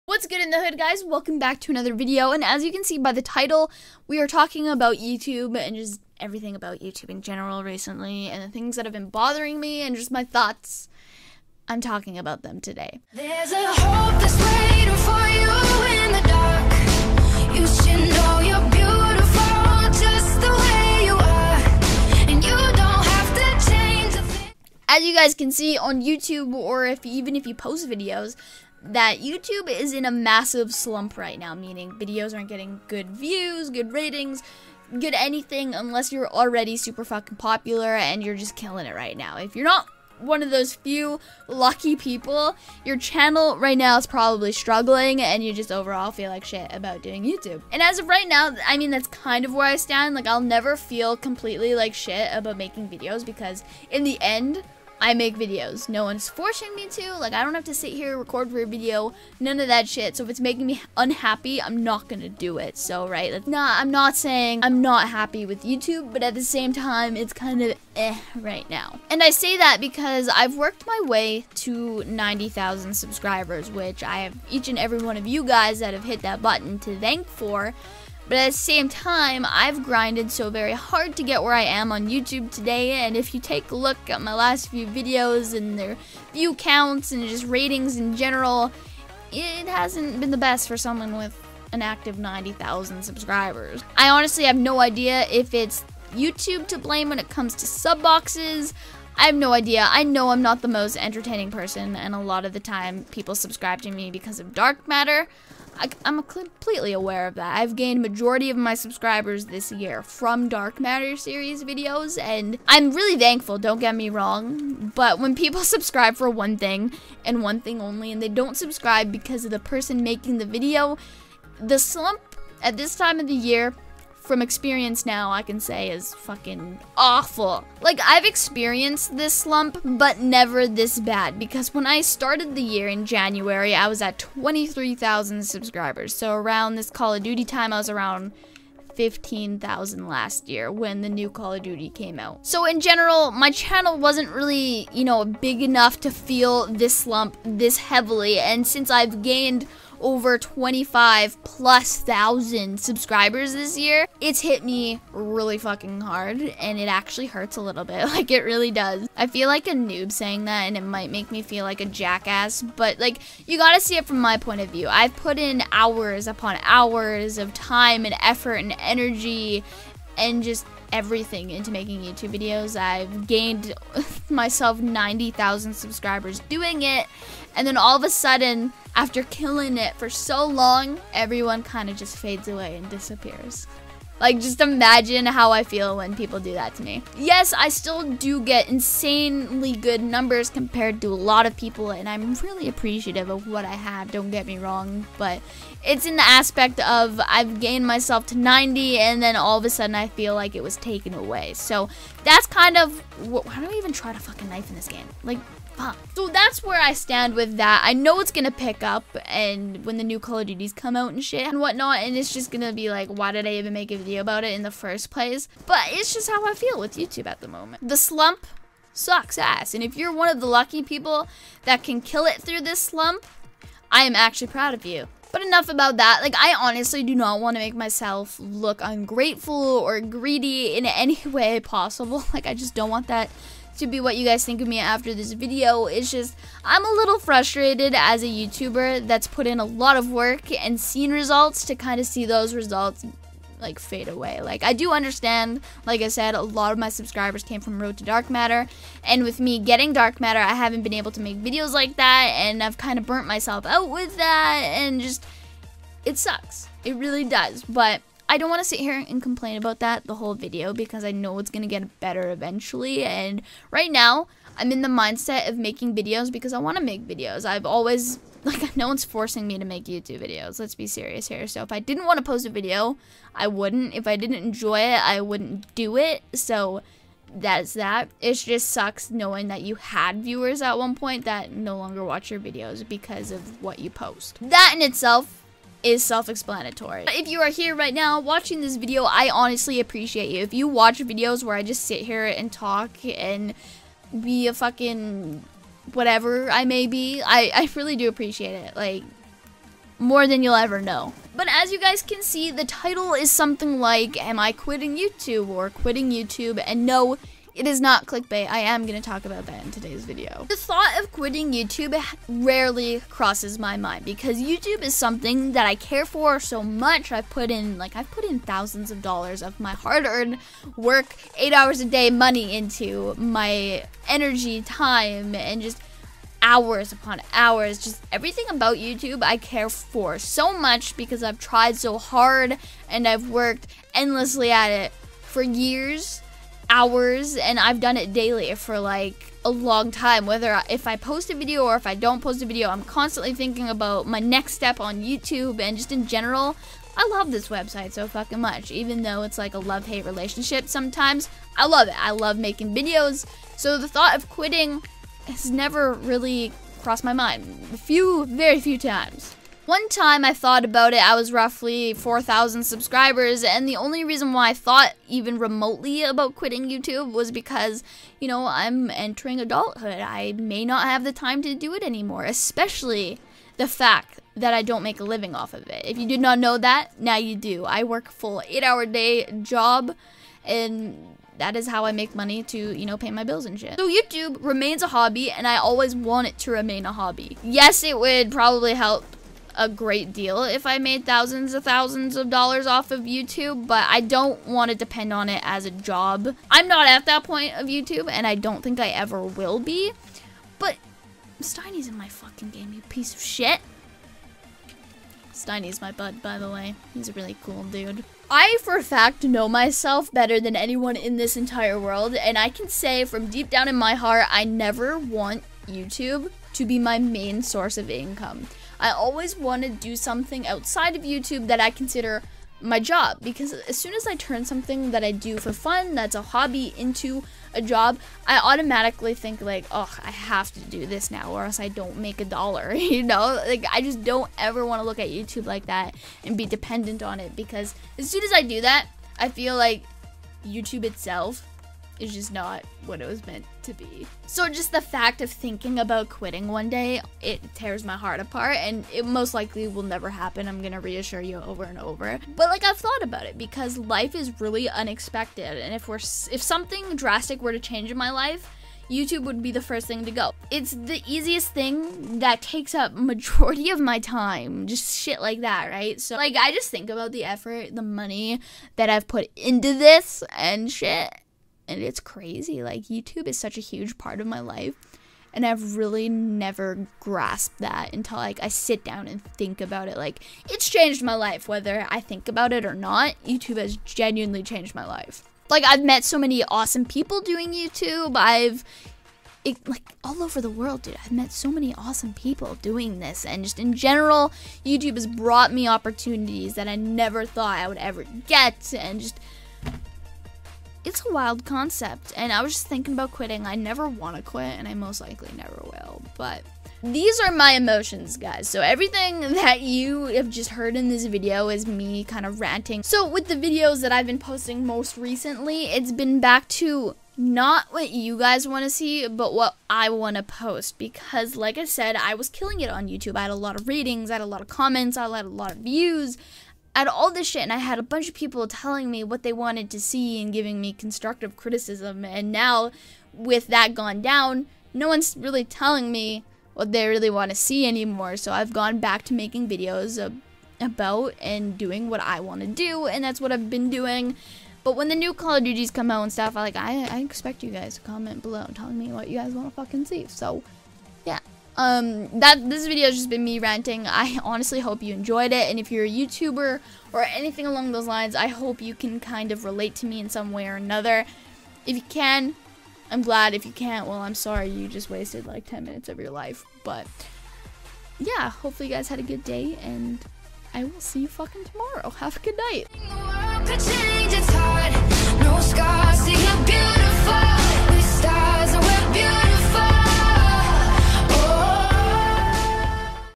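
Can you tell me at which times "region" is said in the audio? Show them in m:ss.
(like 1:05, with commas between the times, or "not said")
not said.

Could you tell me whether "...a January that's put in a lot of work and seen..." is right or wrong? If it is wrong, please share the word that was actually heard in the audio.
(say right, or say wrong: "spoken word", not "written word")
wrong: "YouTuber", not "January".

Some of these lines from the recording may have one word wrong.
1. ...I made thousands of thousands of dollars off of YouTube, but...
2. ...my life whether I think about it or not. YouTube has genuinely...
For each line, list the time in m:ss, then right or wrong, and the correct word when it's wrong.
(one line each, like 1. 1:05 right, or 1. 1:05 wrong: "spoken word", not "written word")
1. 6:30 right
2. 8:01 right.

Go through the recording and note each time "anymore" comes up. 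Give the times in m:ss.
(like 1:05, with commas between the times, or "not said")
6:11, 8:57.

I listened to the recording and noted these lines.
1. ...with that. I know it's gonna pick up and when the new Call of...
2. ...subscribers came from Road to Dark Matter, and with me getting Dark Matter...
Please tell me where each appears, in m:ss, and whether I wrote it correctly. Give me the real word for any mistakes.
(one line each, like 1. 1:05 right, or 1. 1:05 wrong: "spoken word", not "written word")
1. 3:27 right
2. 4:06 right.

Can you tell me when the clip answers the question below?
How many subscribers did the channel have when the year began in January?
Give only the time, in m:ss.
2:14.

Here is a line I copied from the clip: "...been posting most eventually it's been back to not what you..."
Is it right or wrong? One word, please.
wrong.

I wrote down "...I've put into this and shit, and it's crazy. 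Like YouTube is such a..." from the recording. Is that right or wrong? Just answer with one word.
right.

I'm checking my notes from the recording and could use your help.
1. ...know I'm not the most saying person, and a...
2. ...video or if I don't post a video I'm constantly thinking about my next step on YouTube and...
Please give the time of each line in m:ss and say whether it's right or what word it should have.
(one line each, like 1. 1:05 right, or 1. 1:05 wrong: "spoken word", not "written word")
1. 1:40 wrong: "entertaining", not "saying"
2. 5:41 right.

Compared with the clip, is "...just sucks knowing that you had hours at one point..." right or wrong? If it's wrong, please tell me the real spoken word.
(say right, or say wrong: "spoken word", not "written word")
wrong: "viewers", not "hours".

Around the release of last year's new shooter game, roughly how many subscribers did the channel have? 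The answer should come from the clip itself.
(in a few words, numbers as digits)
15,000.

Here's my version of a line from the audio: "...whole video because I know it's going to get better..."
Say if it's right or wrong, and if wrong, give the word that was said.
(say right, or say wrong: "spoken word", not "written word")
right.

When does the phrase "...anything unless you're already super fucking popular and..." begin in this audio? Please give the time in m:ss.
0:35.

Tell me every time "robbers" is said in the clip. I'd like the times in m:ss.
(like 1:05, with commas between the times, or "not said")
not said.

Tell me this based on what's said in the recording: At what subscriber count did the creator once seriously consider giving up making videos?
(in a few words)
4,000.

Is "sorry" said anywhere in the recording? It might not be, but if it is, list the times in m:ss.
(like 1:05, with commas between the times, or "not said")
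9:24.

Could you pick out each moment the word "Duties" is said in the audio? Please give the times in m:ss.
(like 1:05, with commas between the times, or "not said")
3:30, 9:05.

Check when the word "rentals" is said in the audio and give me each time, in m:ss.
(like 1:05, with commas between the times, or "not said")
not said.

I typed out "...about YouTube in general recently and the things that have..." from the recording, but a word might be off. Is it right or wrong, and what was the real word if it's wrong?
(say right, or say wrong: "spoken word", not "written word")
right.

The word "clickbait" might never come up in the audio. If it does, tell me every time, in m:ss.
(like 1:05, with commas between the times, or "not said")
5:08.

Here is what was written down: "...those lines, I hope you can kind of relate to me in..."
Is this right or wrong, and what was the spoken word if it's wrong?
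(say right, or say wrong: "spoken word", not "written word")
right.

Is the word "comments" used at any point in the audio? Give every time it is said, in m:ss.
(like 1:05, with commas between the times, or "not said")
8:44, 9:07.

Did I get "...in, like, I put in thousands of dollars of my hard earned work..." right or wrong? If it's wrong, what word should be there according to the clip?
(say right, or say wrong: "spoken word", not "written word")
right.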